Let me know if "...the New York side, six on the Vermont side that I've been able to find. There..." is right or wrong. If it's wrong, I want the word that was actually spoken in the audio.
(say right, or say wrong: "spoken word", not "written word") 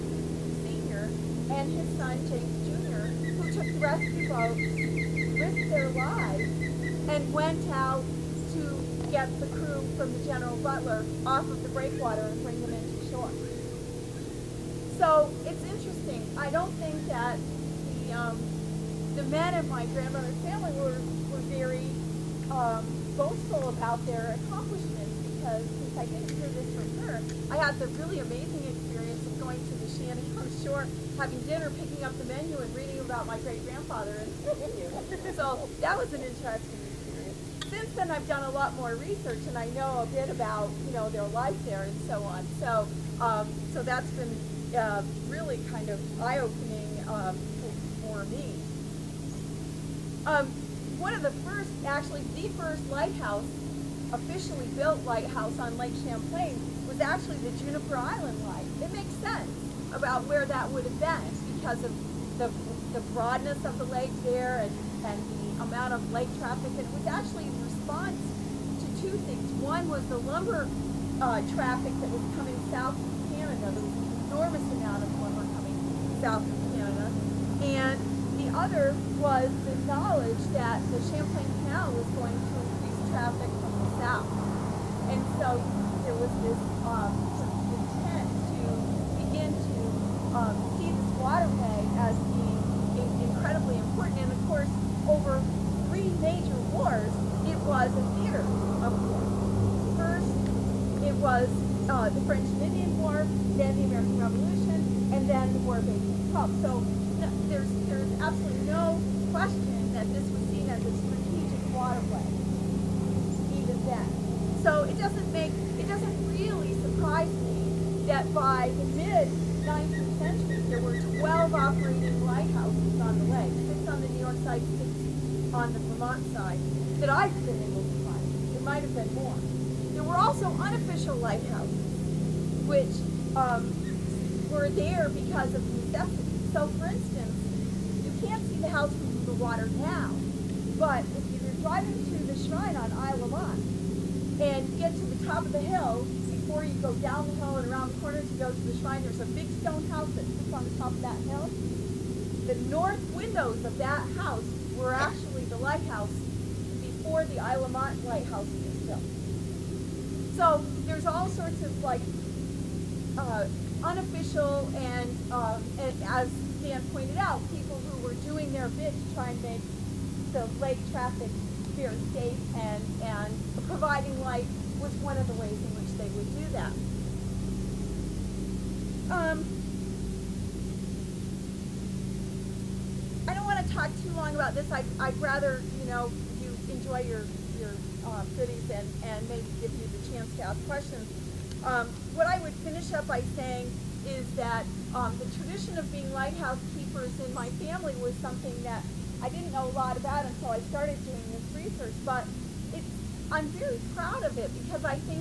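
right.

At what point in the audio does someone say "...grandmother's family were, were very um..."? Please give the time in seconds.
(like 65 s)
19 s.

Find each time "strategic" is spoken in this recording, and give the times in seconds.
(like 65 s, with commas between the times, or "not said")
110 s.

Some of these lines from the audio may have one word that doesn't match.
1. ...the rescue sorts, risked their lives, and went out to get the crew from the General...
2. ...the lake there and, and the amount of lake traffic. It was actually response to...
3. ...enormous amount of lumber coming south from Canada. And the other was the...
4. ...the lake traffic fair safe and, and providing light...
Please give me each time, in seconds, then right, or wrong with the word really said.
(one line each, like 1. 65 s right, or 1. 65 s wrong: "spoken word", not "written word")
1. 3 s wrong: "boats", not "sorts"
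2. 63 s right
3. 74 s right
4. 170 s right.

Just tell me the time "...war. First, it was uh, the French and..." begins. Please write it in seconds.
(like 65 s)
99 s.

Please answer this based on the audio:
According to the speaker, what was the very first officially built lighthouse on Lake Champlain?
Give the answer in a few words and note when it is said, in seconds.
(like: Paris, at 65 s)
Juniper Island light, at 57 s.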